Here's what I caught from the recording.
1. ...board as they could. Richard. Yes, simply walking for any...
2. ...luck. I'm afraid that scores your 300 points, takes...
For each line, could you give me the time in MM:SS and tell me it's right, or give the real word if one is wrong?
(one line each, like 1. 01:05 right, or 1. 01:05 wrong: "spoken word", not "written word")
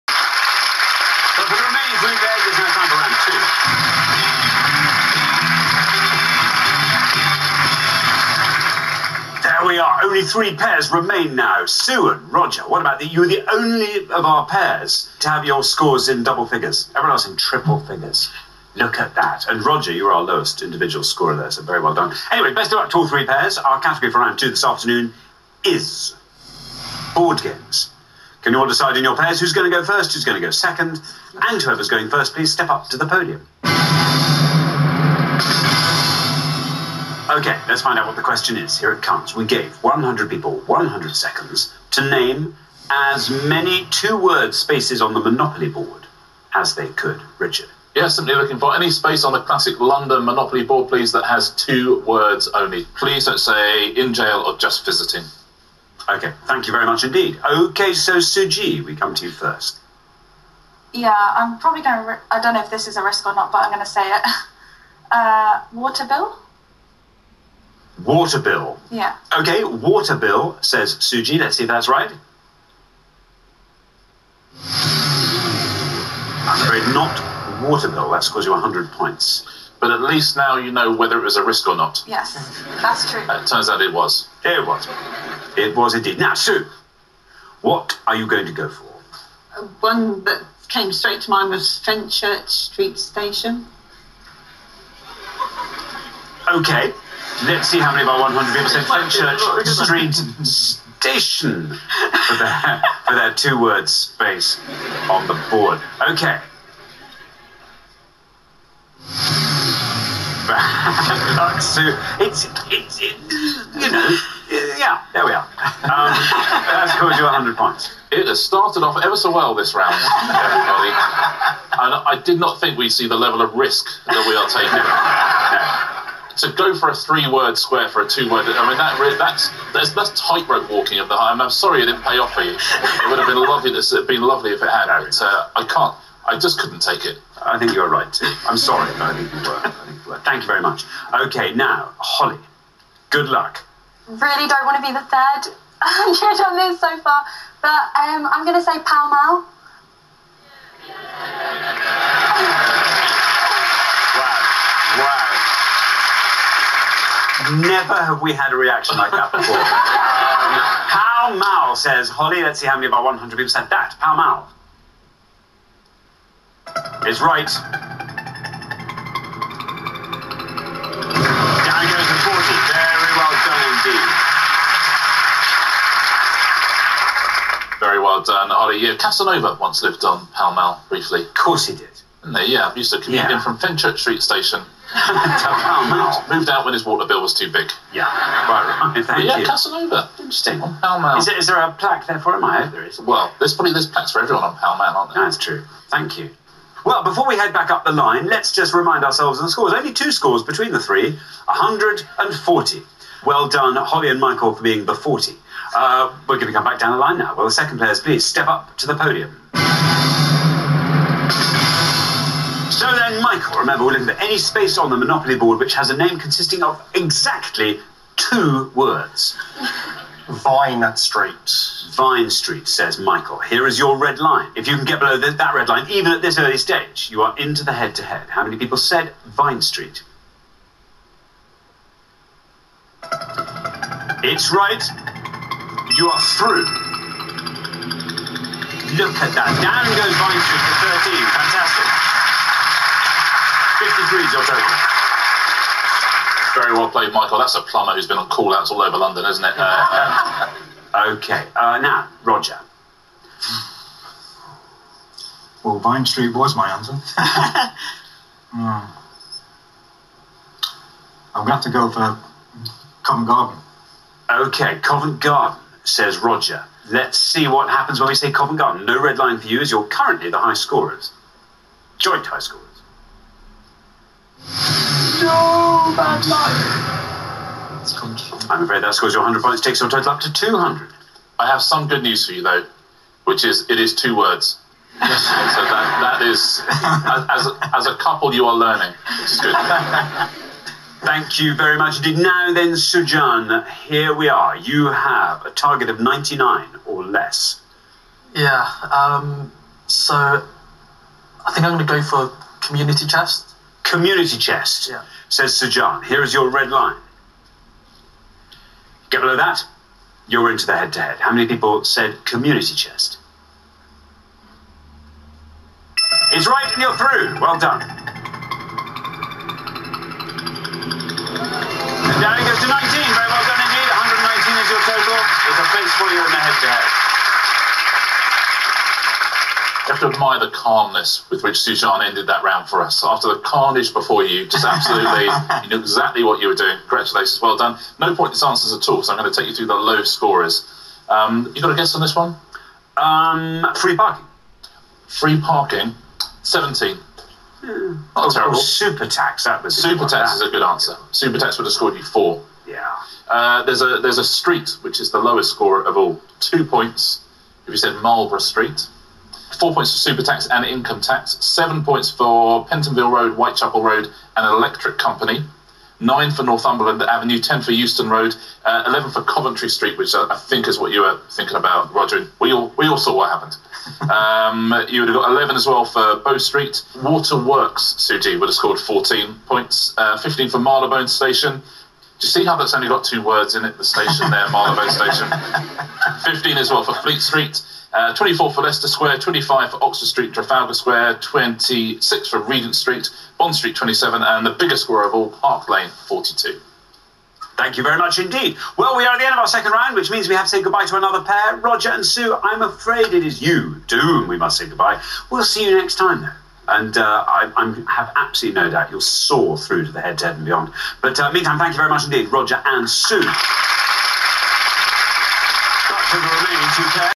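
1. 00:45 wrong: "looking", not "walking"
2. 04:36 wrong: "100", not "300".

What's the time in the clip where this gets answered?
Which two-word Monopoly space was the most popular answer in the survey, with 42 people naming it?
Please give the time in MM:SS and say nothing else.
06:35.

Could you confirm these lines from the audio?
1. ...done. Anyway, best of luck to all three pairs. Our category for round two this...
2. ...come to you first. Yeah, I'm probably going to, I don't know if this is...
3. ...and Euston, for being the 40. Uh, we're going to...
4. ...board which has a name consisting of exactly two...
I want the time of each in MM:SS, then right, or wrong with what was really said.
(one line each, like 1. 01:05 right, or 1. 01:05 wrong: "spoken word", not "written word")
1. 00:21 right
2. 00:58 right
3. 03:24 wrong: "Michael", not "Euston"
4. 03:35 right.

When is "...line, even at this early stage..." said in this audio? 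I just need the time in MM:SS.
03:45.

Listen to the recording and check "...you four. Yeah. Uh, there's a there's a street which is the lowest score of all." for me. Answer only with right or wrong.
right.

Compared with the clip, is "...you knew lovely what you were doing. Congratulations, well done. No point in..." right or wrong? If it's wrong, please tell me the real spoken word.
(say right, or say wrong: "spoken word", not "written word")
wrong: "exactly", not "lovely".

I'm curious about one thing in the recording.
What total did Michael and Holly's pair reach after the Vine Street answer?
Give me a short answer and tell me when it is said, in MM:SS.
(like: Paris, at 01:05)
53, at 04:03.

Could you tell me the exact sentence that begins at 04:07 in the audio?
That's a plumber who's been on call-outs all over London, isn't it?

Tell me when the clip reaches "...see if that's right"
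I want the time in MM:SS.
01:11.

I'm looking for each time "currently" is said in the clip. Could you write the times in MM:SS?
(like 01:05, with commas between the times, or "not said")
04:29.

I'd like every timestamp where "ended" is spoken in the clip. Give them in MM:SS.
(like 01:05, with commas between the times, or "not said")
05:32.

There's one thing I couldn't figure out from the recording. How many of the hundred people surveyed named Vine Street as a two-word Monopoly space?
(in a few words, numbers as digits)
13.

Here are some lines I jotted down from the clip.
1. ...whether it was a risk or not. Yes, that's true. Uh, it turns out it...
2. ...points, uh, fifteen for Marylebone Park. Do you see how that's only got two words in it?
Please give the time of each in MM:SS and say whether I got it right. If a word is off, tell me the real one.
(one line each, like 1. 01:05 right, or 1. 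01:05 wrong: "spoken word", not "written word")
1. 01:20 right
2. 06:19 wrong: "Station", not "Park".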